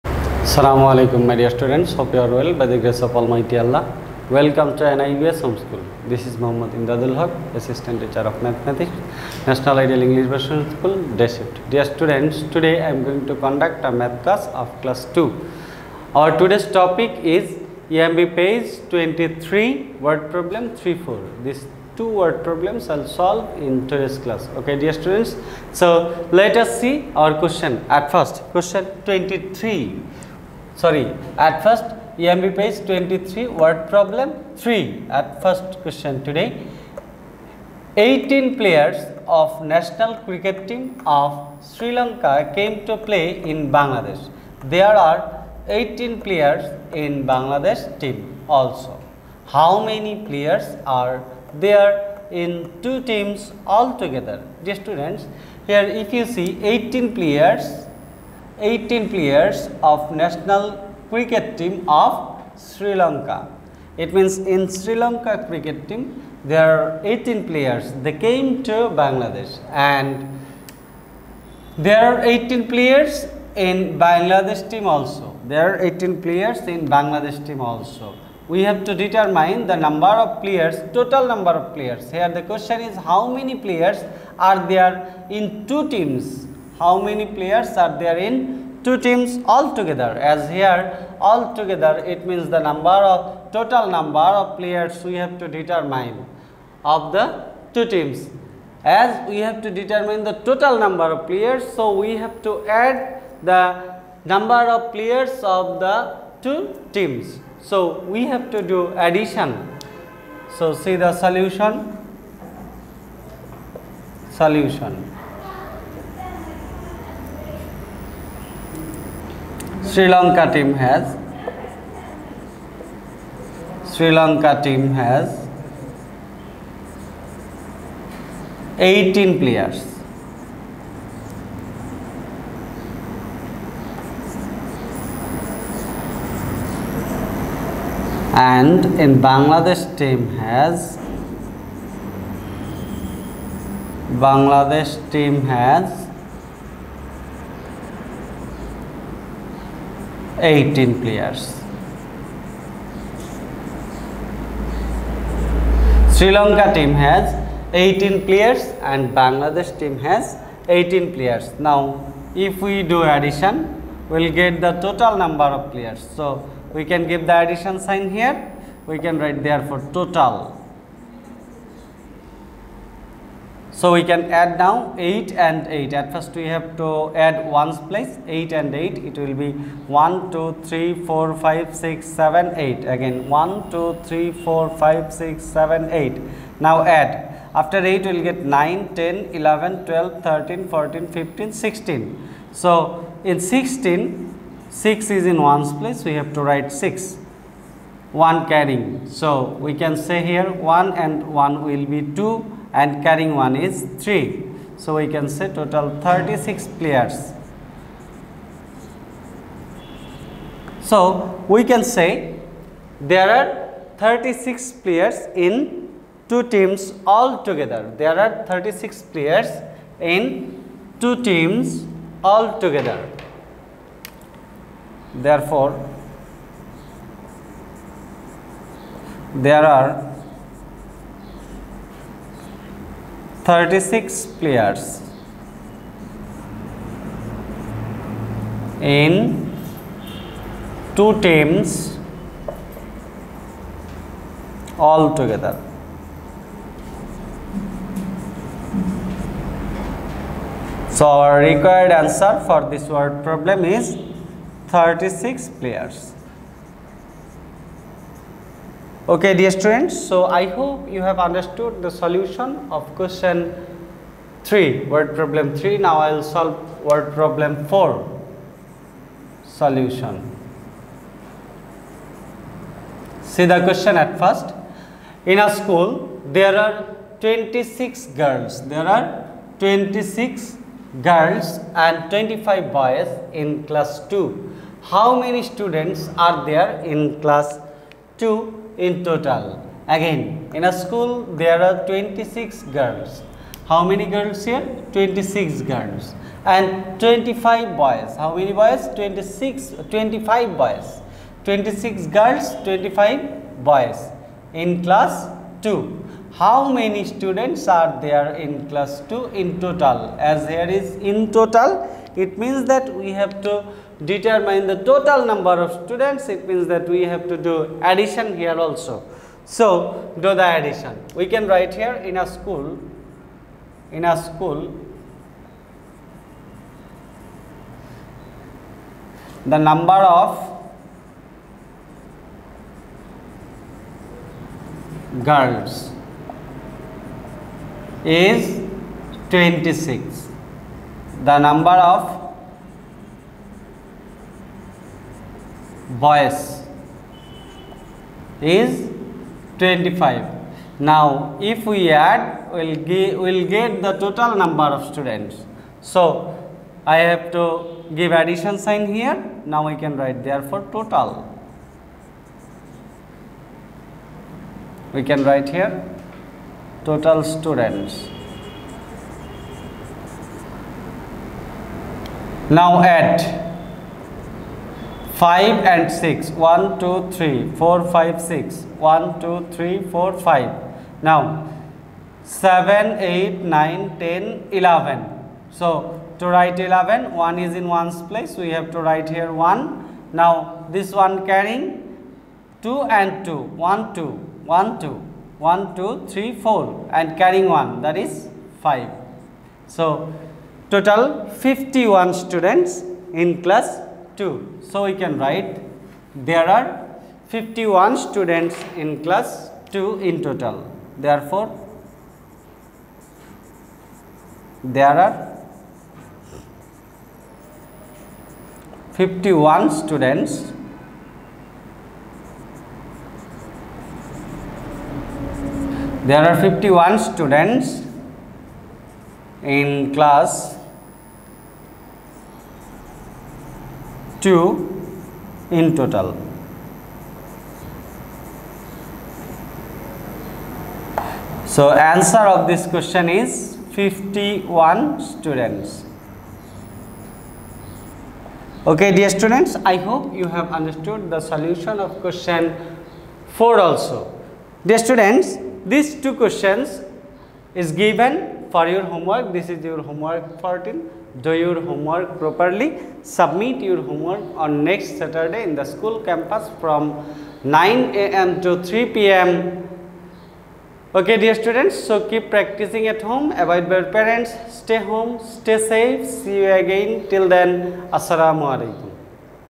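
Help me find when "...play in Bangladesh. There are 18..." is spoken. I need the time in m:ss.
0:42.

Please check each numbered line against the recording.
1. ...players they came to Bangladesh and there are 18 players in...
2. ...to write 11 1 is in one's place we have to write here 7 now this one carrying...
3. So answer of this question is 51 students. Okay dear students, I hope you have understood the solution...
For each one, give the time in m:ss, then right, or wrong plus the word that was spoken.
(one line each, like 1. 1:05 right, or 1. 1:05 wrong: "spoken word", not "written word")
1. 1:07 right
2. 6:26 wrong: "1", not "7"
3. 7:21 right.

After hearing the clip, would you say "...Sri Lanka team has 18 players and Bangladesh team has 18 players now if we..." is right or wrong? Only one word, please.
right.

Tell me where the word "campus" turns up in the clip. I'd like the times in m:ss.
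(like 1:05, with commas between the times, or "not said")
7:46.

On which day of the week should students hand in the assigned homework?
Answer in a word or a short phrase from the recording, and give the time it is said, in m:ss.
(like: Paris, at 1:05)
Saturday, at 7:44.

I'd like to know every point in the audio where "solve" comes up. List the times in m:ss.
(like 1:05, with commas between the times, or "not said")
0:23, 4:26.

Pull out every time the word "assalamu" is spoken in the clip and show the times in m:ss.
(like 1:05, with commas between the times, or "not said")
0:00, 7:57.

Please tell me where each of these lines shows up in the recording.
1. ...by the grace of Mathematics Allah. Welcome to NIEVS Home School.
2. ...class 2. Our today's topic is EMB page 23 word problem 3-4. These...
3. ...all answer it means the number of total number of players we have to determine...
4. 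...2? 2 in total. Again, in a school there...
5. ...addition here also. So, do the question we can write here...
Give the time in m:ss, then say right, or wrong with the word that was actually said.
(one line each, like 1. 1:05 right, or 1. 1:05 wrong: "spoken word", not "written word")
1. 0:02 wrong: "Almighty", not "Mathematics"
2. 0:14 right
3. 1:31 wrong: "together", not "answer"
4. 4:47 right
5. 5:17 wrong: "addition", not "question".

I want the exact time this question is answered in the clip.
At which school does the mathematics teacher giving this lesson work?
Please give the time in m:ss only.
0:09.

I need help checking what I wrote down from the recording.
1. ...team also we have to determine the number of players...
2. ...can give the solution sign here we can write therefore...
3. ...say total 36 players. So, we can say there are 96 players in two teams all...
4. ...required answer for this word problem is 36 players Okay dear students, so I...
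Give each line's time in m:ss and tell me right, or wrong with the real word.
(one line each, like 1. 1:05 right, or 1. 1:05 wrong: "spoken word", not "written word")
1. 1:17 right
2. 2:46 wrong: "addition", not "solution"
3. 3:25 wrong: "36", not "96"
4. 4:11 right.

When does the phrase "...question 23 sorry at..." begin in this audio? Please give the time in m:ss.
0:28.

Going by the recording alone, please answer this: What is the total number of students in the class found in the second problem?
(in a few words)
51.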